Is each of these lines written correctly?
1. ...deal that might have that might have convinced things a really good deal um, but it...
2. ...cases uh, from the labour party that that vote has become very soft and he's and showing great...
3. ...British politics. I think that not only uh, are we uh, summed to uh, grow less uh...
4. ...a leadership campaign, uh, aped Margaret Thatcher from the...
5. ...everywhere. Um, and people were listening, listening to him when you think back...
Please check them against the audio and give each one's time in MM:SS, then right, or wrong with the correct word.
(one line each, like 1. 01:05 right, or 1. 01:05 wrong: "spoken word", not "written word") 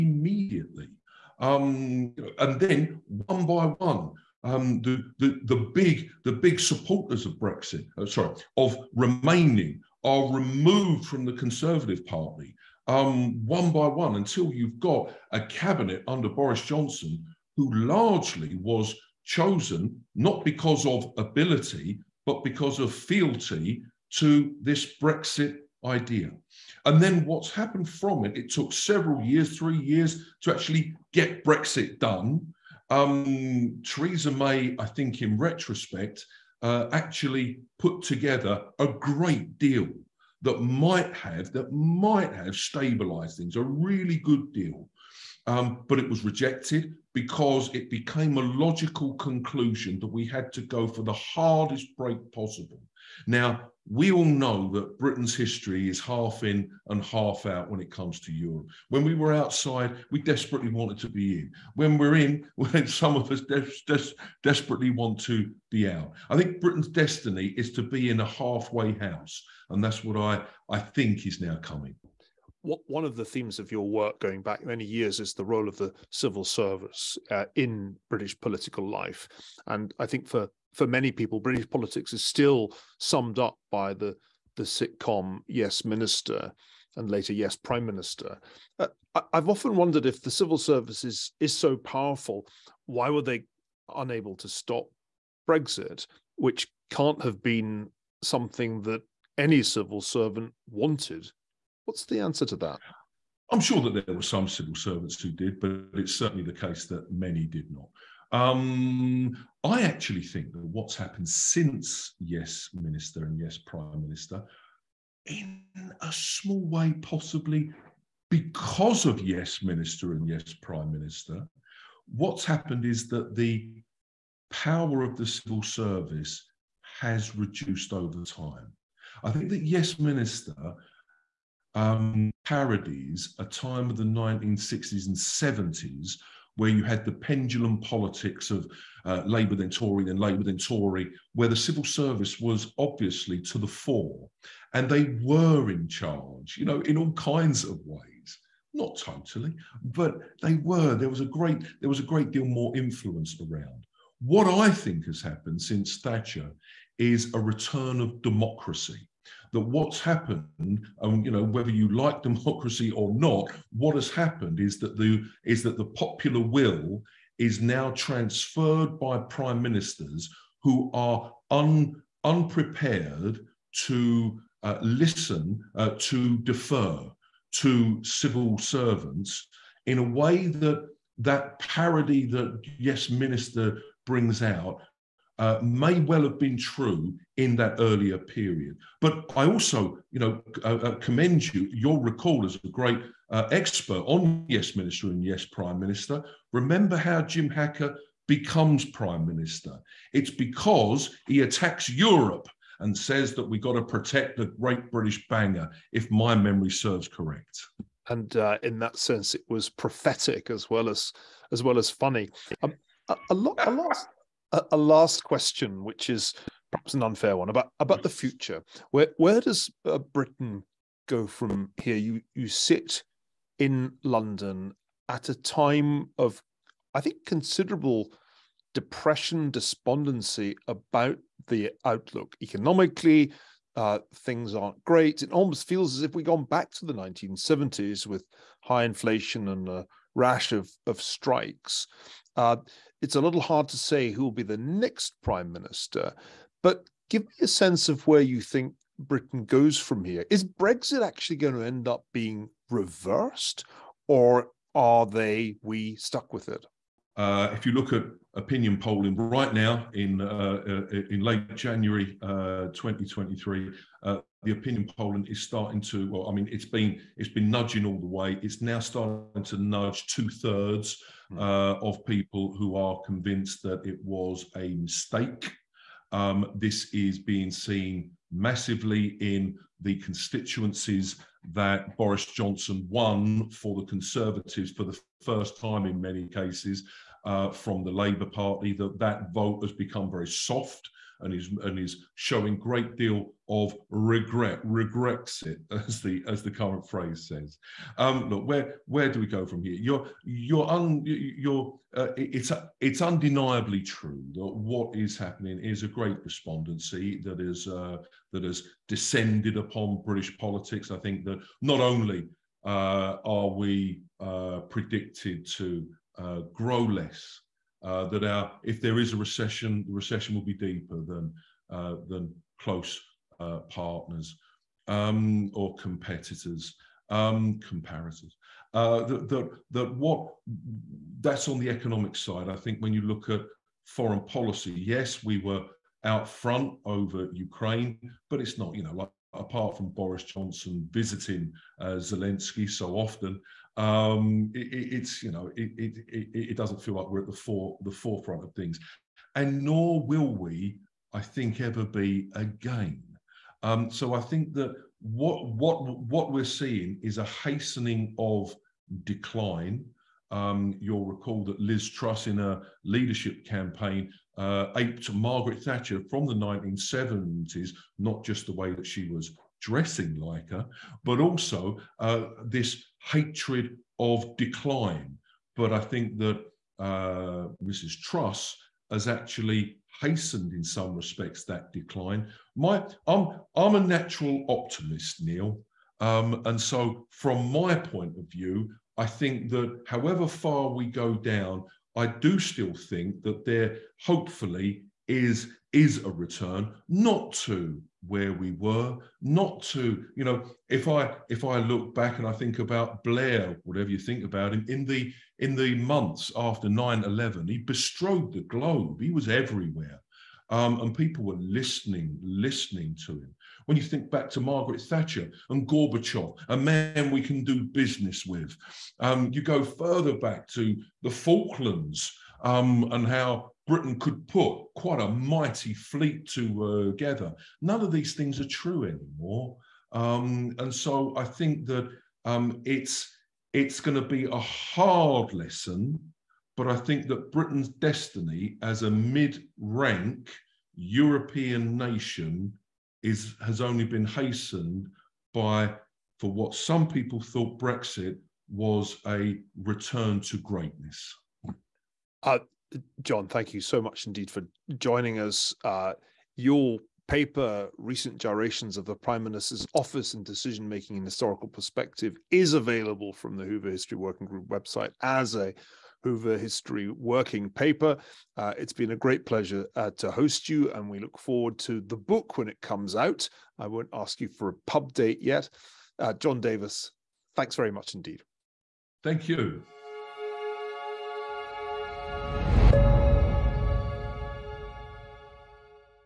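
1. 00:39 wrong: "stabilized", not "convinced"
2. 04:46 right
3. 05:10 wrong: "predicted", not "summed"
4. 06:02 right
5. 06:49 right.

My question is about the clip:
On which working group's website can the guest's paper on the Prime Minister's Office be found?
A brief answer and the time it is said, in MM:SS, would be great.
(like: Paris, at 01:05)
Hoover History Working Group, at 07:43.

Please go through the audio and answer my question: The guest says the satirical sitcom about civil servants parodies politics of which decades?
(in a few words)
1960s and 70s.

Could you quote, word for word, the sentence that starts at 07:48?
Uh, it's been a great pleasure uh, to host you, and we look forward to the book when it comes out.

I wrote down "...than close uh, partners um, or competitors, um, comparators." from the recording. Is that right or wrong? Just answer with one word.
right.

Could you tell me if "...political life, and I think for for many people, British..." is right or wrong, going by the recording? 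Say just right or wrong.
right.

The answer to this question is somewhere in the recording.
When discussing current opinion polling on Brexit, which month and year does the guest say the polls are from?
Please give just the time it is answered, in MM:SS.
04:21.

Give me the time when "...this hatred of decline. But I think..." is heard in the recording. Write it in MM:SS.
06:12.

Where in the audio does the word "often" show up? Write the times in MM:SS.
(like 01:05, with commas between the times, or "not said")
01:29, 05:42.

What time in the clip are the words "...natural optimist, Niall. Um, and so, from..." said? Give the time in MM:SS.
06:23.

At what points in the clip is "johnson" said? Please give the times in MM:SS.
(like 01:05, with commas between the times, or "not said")
00:16, 04:42, 05:40.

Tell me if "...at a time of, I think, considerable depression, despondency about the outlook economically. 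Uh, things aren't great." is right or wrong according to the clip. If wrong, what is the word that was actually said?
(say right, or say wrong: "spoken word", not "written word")
right.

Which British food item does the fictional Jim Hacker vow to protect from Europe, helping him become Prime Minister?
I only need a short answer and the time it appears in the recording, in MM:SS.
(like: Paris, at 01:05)
British banger, at 03:24.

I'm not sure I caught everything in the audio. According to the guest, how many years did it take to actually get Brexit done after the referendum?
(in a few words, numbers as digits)
3 years.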